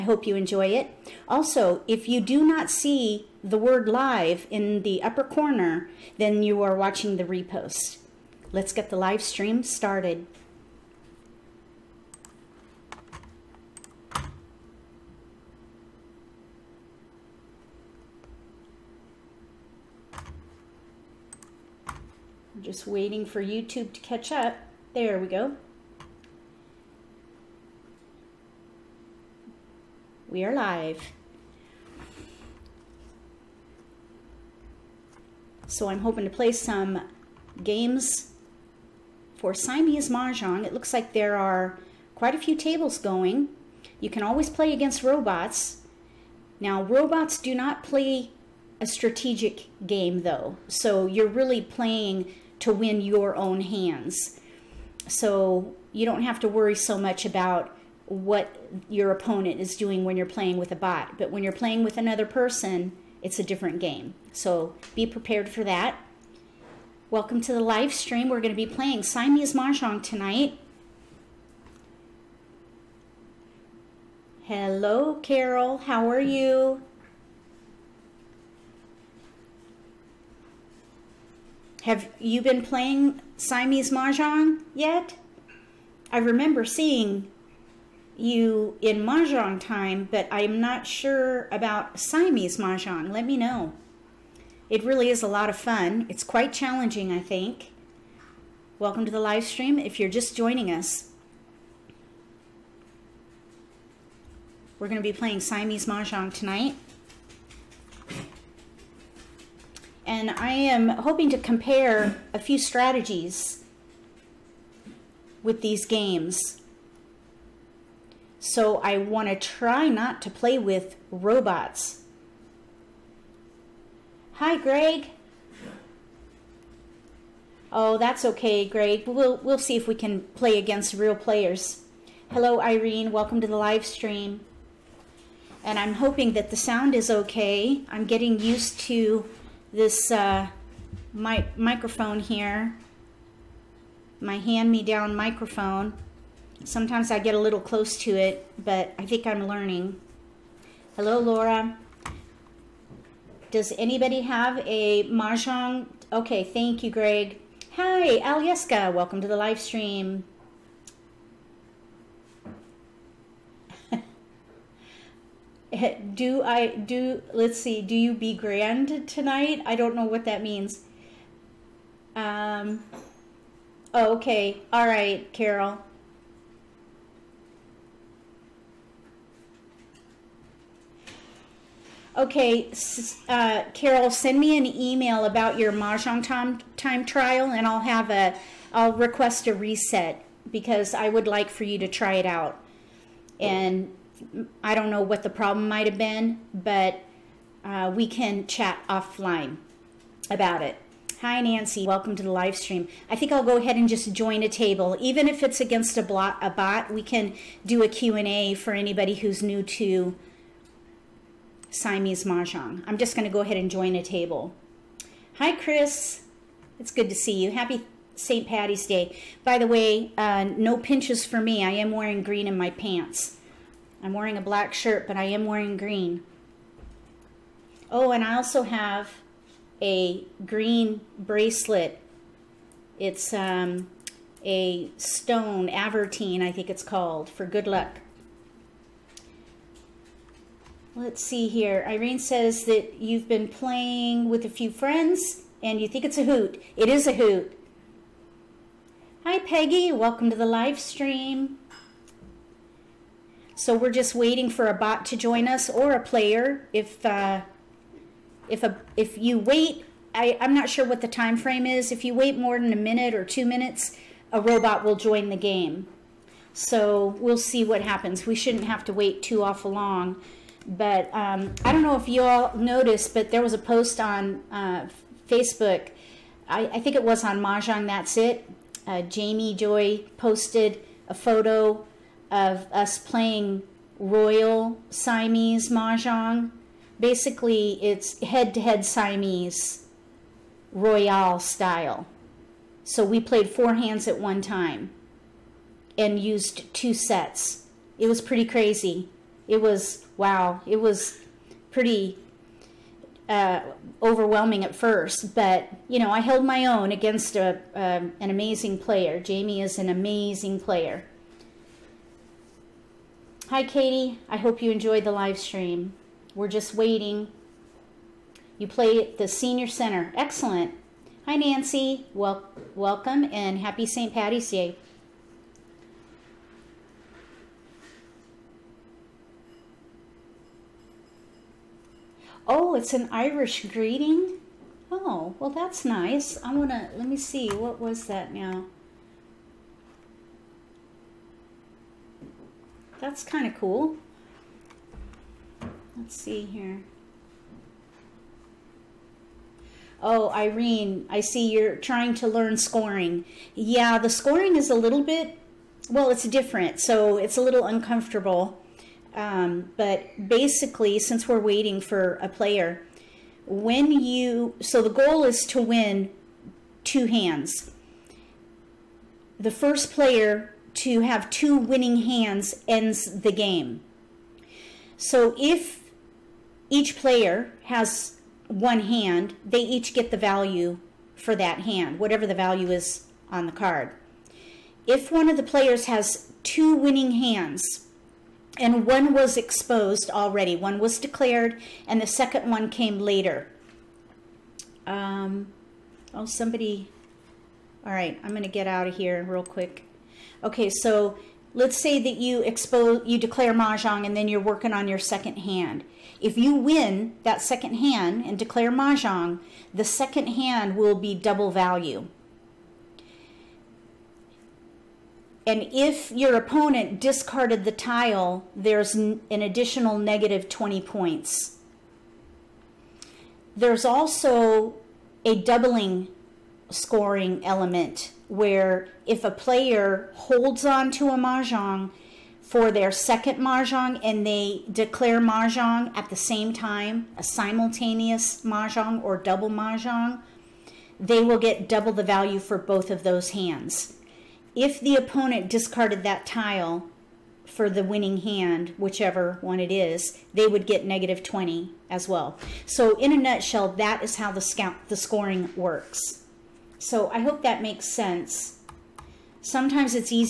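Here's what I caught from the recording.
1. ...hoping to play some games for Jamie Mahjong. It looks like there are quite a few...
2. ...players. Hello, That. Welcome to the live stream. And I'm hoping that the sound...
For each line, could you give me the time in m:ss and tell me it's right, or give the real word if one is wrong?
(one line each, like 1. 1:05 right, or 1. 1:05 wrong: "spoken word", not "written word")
1. 0:36 wrong: "Siamese", not "Jamie"
2. 2:11 wrong: "Irene", not "That".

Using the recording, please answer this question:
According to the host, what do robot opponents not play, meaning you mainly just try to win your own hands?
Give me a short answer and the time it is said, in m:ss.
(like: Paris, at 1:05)
a strategic game, at 0:48.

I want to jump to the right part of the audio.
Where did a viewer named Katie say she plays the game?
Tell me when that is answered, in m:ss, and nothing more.
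5:19.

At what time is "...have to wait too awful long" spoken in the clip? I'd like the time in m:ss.
4:28.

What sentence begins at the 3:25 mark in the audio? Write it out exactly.
Even if it's against a, a bot, we can do a Q&A for anybody who's new to Siamese Mahjong.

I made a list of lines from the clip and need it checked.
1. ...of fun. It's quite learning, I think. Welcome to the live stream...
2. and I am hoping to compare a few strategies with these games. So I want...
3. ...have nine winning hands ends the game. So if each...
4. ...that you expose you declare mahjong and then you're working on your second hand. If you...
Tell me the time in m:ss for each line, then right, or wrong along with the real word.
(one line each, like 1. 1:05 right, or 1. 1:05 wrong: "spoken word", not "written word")
1. 1:35 wrong: "challenging", not "learning"
2. 1:50 right
3. 6:11 wrong: "two", not "nine"
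4. 6:42 right.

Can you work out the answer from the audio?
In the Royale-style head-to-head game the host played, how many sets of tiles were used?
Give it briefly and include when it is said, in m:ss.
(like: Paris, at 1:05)
2, at 4:56.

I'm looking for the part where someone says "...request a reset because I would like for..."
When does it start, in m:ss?
3:08.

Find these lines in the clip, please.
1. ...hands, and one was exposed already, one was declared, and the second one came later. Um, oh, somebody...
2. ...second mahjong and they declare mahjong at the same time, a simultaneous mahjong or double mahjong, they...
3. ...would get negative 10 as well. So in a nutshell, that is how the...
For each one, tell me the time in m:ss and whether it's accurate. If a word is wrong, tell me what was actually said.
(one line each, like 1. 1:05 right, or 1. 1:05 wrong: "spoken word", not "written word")
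1. 6:27 right
2. 7:12 right
3. 7:30 wrong: "20", not "10".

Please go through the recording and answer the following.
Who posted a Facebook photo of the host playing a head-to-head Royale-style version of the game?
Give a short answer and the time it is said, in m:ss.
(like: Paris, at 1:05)
Jamie Joy, at 4:39.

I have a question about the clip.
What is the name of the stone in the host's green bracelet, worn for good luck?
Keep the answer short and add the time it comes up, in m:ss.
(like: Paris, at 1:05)
aventurine, at 3:55.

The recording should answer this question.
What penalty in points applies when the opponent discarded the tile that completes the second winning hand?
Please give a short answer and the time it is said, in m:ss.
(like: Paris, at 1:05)
-20, at 6:59.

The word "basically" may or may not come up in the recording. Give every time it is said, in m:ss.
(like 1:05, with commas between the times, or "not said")
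4:46, 6:00.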